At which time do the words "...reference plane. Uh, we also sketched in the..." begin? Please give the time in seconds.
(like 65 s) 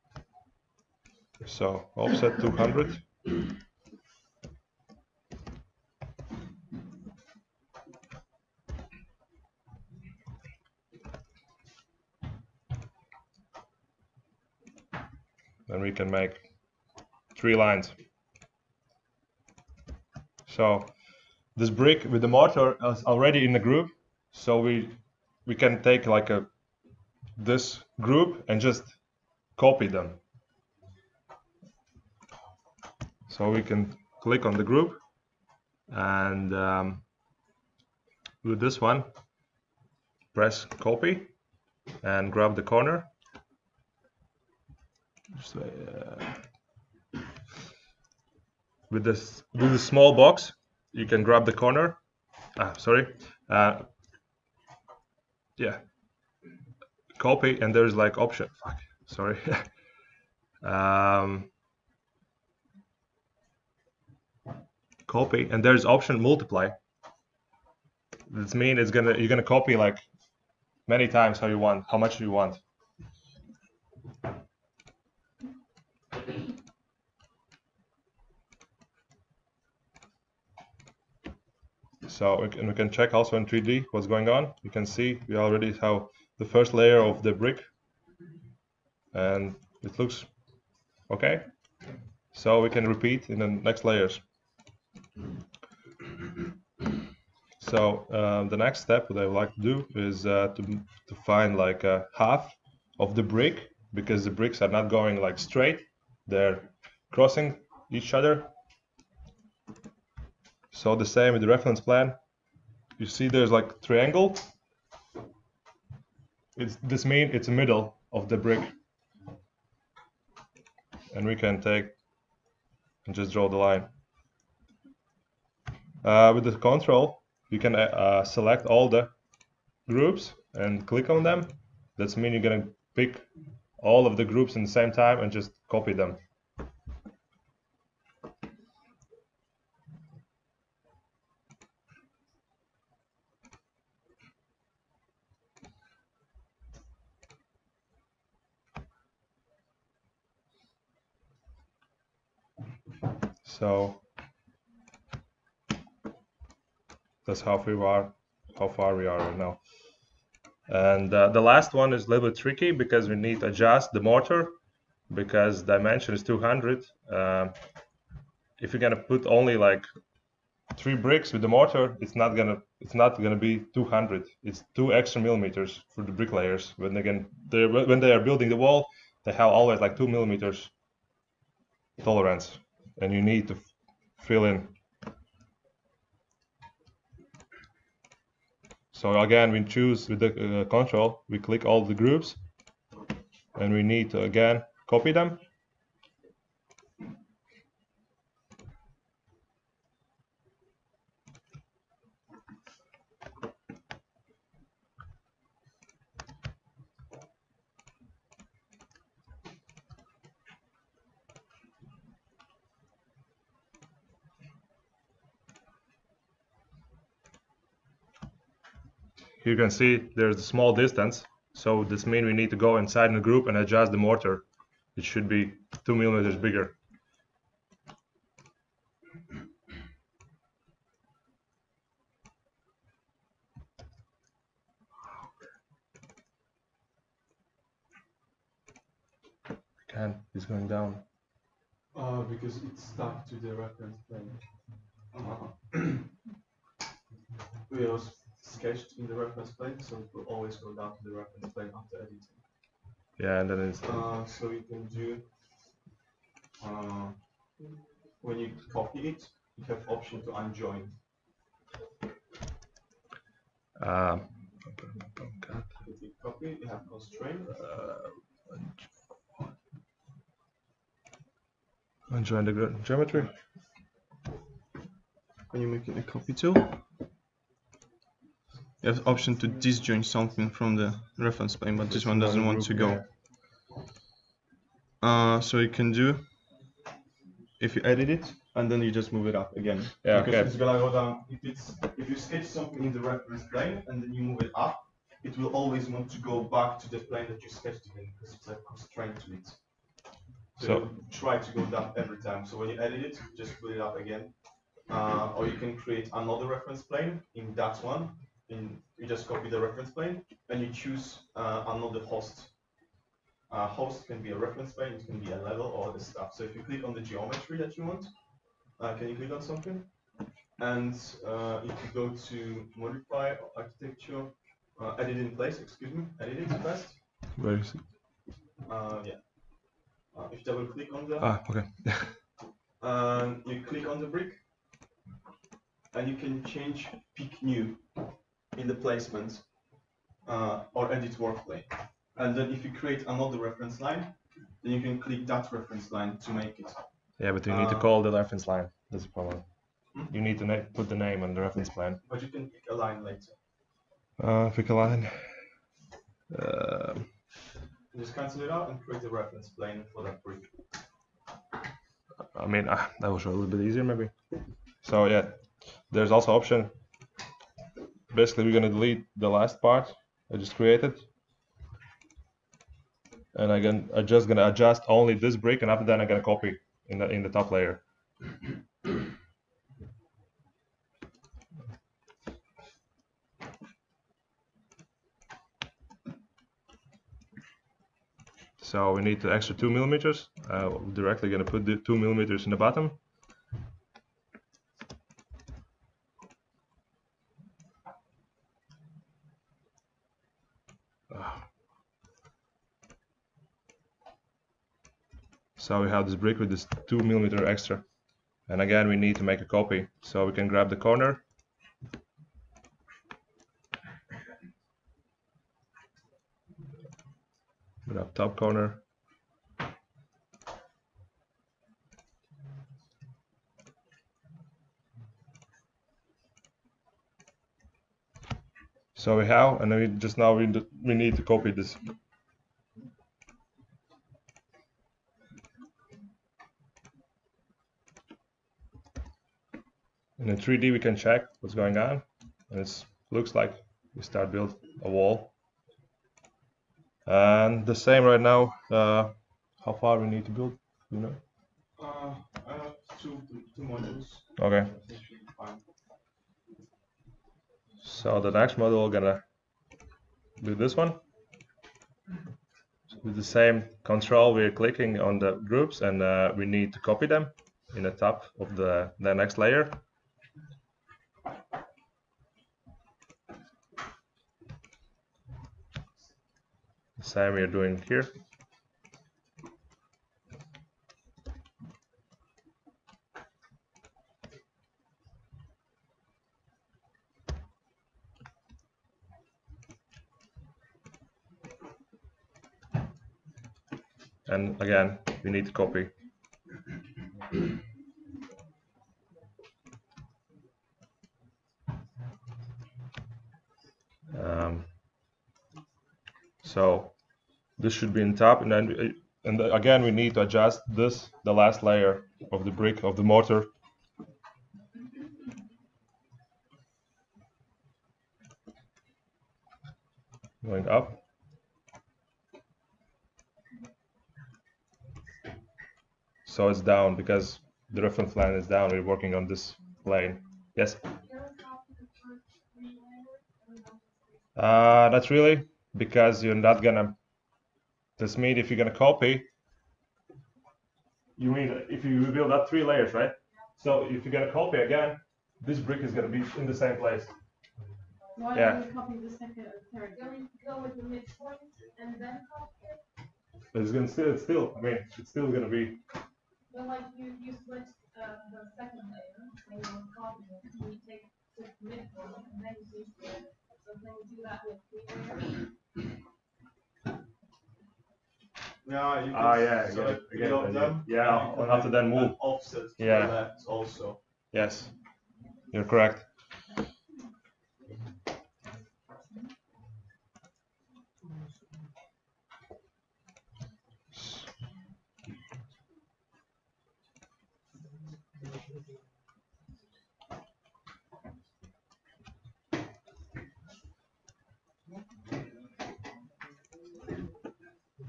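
243 s.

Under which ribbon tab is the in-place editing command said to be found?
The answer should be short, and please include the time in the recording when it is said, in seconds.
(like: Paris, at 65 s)
modify architecture, at 322 s.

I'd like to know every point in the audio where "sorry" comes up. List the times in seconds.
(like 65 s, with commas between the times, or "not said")
52 s, 59 s.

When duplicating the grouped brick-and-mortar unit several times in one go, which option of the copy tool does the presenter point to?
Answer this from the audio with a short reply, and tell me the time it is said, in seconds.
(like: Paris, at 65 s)
multiply, at 66 s.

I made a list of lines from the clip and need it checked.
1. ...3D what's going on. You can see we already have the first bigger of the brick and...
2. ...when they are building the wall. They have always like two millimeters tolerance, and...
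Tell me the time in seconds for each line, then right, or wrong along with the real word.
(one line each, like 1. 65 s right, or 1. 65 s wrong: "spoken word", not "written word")
1. 83 s wrong: "layer", not "bigger"
2. 177 s right.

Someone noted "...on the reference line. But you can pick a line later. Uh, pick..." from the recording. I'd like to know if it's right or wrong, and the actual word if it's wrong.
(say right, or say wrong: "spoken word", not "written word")
right.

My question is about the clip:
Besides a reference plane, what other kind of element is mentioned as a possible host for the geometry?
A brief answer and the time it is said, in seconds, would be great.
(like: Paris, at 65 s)
a level, at 315 s.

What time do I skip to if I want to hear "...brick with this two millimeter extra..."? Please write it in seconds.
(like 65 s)
406 s.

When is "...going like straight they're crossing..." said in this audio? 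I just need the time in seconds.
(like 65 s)
104 s.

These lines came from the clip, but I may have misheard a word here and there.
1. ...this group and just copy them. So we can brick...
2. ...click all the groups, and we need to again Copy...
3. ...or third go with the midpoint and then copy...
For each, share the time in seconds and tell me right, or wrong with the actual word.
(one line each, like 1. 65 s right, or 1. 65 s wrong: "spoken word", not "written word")
1. 27 s wrong: "click", not "brick"
2. 191 s right
3. 549 s right.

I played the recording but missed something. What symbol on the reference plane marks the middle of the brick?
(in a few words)
triangle.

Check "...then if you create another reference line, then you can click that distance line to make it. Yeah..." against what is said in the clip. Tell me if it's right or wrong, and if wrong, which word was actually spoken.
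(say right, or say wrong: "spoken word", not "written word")
wrong: "reference", not "distance".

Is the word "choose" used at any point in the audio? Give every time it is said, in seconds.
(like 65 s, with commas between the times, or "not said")
189 s, 310 s.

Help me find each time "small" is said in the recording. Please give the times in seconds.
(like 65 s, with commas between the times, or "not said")
49 s, 220 s.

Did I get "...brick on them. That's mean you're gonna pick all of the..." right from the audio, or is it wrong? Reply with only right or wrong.
wrong.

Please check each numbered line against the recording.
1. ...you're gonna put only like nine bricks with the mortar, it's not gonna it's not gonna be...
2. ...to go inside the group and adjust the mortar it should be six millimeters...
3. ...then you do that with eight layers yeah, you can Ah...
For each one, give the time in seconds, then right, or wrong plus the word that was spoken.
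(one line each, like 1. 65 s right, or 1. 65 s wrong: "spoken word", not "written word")
1. 168 s wrong: "three", not "nine"
2. 222 s wrong: "two", not "six"
3. 563 s wrong: "three", not "eight".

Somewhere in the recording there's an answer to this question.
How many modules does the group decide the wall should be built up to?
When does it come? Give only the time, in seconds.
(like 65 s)
453 s.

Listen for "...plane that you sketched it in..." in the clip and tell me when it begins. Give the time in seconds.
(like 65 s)
296 s.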